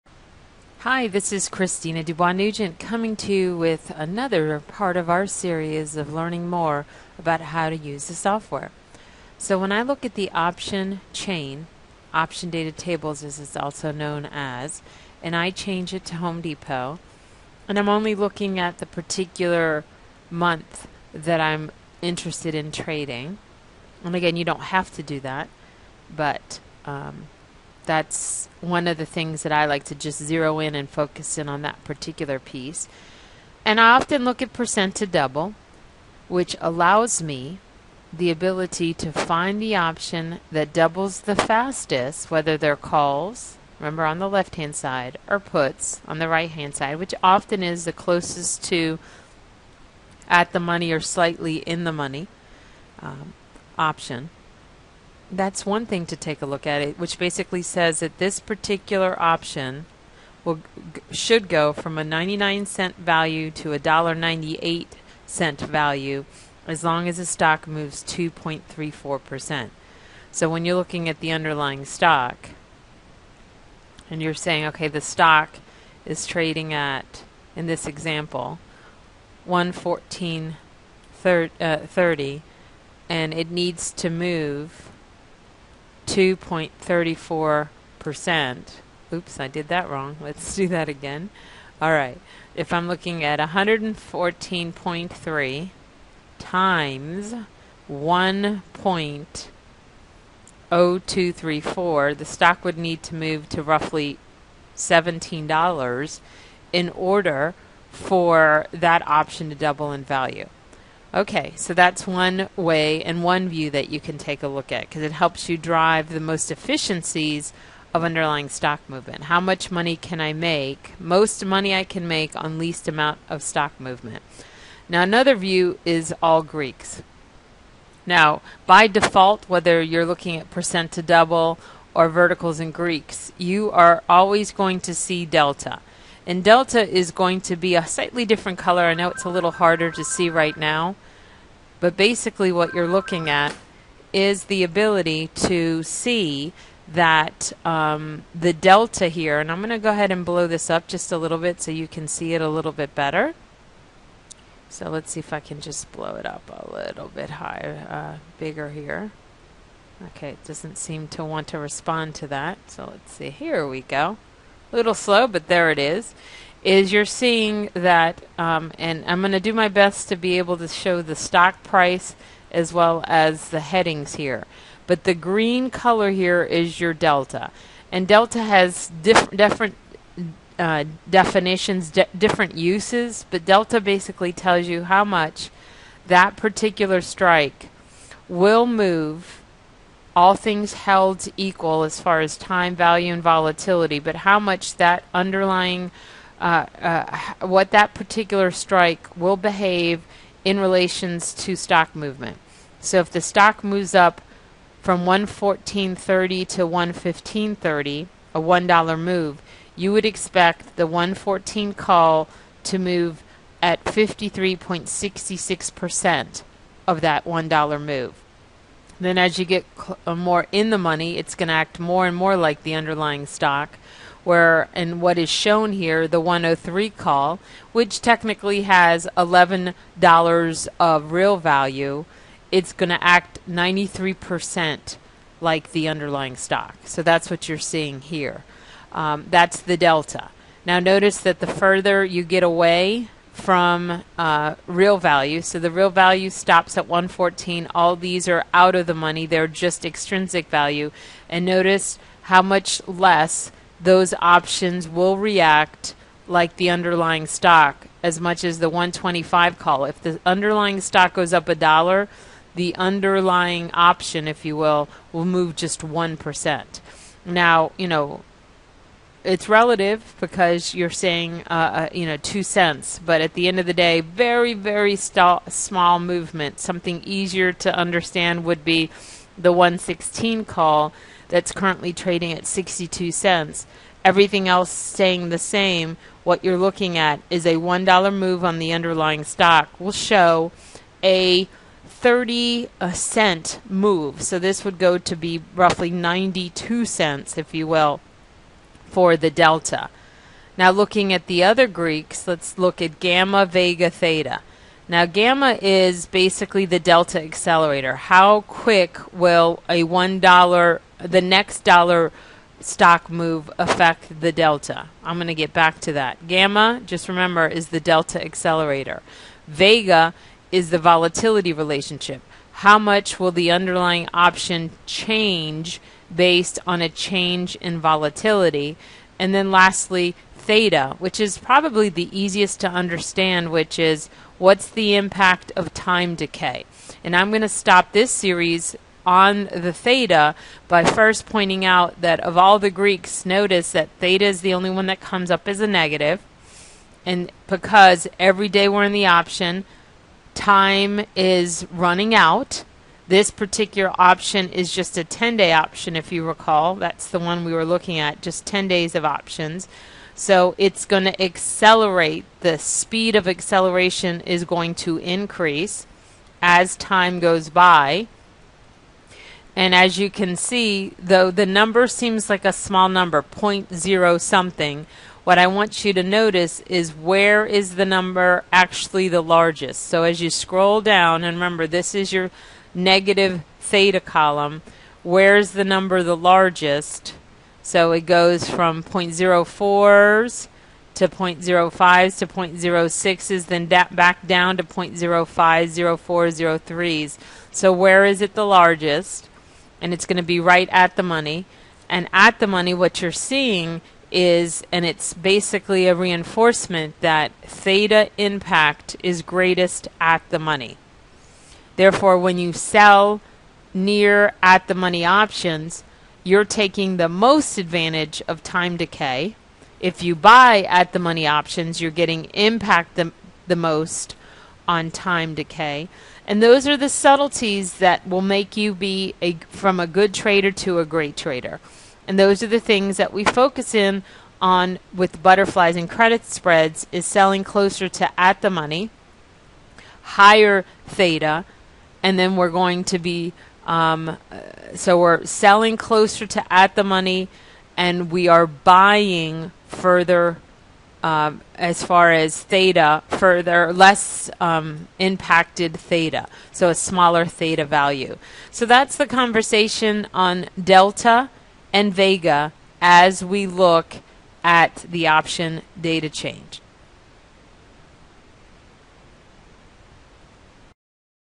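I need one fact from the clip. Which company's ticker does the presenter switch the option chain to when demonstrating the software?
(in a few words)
Home Depot.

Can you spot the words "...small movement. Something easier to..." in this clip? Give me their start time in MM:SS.
04:35.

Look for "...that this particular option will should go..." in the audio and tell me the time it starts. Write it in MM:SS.
00:58.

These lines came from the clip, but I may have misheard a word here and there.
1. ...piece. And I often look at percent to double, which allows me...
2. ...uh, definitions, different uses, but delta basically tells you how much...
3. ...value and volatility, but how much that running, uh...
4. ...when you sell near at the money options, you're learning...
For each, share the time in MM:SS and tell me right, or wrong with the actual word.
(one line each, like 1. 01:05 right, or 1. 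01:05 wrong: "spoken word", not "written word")
1. 00:32 right
2. 03:00 right
3. 03:12 wrong: "underlying", not "running"
4. 06:52 wrong: "taking", not "learning".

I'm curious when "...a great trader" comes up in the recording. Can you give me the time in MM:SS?
07:10.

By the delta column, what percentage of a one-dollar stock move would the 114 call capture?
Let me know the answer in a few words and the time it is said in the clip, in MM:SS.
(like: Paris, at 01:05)
53.66%, at 03:33.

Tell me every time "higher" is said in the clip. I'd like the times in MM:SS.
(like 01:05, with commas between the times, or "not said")
02:37, 07:20.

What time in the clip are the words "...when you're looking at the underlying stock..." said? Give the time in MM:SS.
01:10.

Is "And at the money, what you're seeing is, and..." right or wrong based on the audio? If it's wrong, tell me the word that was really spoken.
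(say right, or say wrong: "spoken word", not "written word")
right.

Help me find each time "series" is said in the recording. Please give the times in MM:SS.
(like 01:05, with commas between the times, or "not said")
00:05, 05:38.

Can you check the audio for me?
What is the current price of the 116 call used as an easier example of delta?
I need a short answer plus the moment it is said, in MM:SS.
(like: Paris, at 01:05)
62 cents, at 04:42.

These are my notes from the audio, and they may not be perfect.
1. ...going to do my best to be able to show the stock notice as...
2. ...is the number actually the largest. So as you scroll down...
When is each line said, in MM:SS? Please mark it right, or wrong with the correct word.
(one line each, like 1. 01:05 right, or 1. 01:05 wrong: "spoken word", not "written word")
1. 02:49 wrong: "price", not "notice"
2. 06:17 right.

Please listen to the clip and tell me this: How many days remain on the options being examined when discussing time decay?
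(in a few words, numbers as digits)
10 days.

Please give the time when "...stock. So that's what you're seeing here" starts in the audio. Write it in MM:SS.
03:56.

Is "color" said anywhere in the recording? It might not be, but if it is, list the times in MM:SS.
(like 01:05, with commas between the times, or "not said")
02:18, 02:55.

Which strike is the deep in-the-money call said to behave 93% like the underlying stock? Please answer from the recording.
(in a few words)
103.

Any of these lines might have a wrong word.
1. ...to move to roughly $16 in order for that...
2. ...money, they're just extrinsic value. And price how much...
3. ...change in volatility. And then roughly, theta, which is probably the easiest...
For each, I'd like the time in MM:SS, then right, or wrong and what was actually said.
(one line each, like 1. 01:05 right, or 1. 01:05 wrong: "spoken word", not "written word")
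1. 01:43 wrong: "17", not "16"
2. 04:08 wrong: "notice", not "price"
3. 05:26 wrong: "lastly", not "roughly".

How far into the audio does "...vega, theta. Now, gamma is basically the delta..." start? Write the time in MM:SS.
05:03.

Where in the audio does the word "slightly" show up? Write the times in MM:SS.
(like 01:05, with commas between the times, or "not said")
00:50, 02:17.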